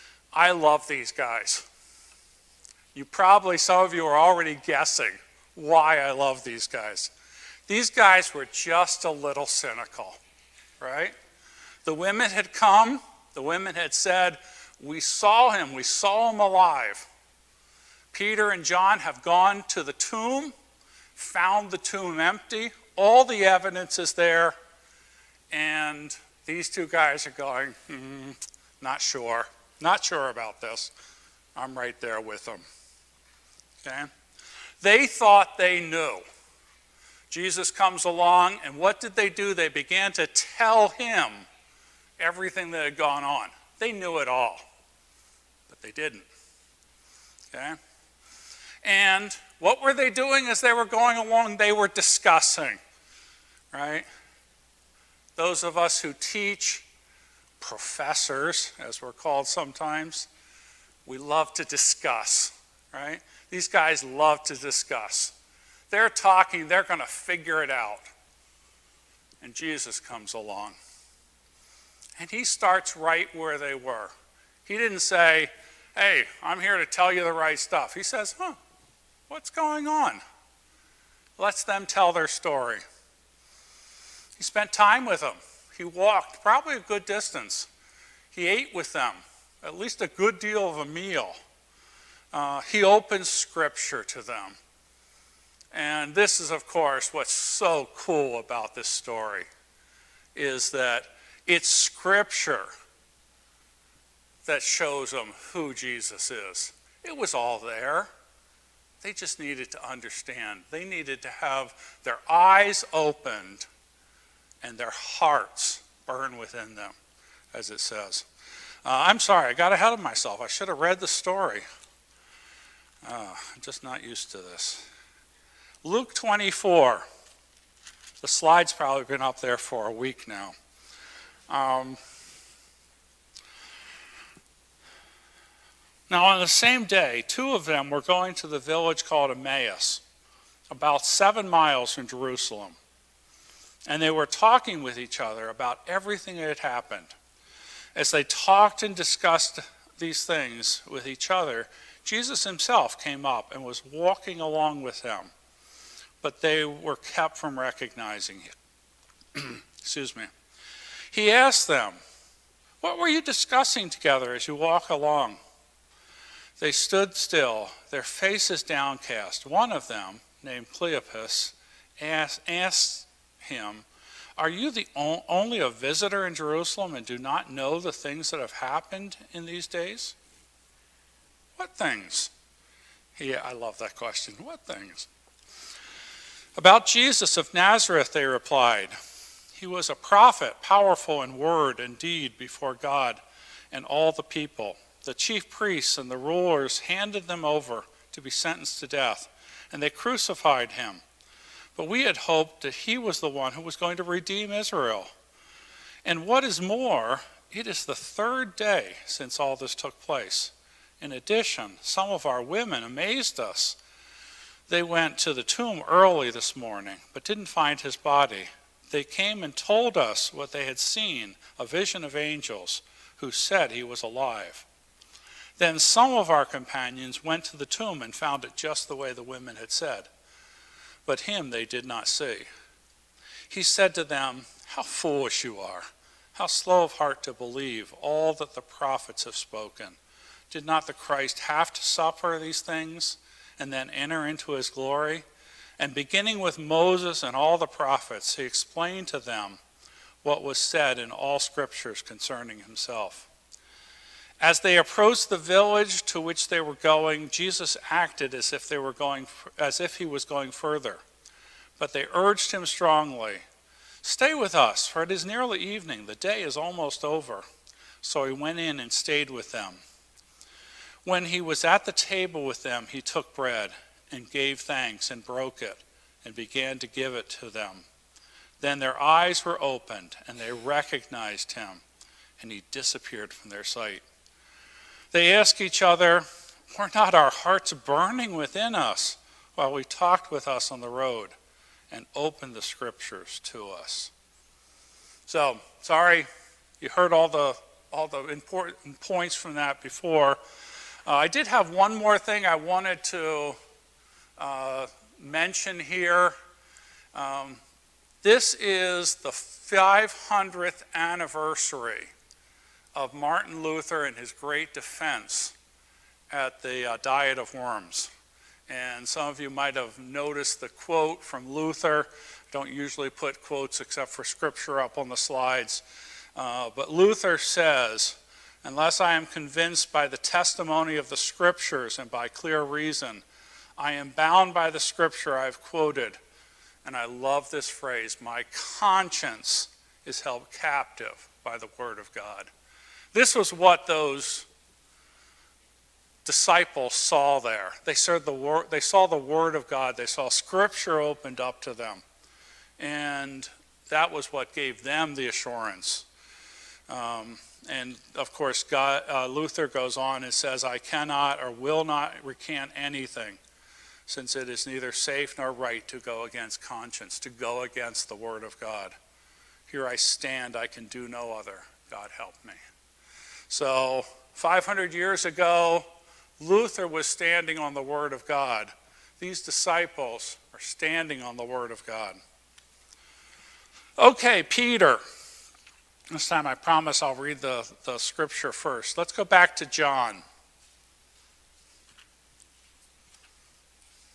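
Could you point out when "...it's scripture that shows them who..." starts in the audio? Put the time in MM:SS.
01:41.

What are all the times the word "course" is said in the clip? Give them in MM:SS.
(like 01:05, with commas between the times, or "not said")
01:36, 05:58.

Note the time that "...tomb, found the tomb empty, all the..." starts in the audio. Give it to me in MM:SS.
00:19.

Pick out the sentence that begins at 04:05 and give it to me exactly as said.
And beginning with Moses and all the prophets, he explained to them what was said in all scriptures concerning himself.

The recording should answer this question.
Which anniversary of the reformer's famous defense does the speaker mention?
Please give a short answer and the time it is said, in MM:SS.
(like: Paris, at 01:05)
500th, at 05:09.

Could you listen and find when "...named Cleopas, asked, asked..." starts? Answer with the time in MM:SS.
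02:50.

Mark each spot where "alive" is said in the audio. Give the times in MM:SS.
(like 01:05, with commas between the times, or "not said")
00:16, 03:44.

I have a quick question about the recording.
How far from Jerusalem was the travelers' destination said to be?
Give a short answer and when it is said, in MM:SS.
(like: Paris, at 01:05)
7 miles, at 02:21.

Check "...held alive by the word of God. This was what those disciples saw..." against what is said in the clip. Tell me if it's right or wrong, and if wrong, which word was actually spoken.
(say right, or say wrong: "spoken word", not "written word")
wrong: "captive", not "alive".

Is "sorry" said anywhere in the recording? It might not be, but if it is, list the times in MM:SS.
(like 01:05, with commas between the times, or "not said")
01:59, 04:55.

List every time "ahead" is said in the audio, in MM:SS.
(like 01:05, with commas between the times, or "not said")
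01:59.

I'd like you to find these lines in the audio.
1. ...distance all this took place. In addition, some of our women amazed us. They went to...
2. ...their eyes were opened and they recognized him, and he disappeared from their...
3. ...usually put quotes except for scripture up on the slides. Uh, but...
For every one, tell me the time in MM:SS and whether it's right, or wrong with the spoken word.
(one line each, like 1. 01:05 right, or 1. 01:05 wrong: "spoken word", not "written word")
1. 03:29 wrong: "since", not "distance"
2. 04:38 right
3. 05:22 right.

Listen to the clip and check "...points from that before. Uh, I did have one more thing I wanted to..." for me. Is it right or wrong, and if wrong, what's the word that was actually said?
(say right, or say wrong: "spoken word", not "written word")
right.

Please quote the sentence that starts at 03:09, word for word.
He was a prophet, powerful in word and deed before God and all the people.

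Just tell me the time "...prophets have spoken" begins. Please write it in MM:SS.
03:58.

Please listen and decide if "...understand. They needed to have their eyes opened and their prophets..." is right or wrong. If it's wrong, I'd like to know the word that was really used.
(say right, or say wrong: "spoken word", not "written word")
wrong: "hearts", not "prophets".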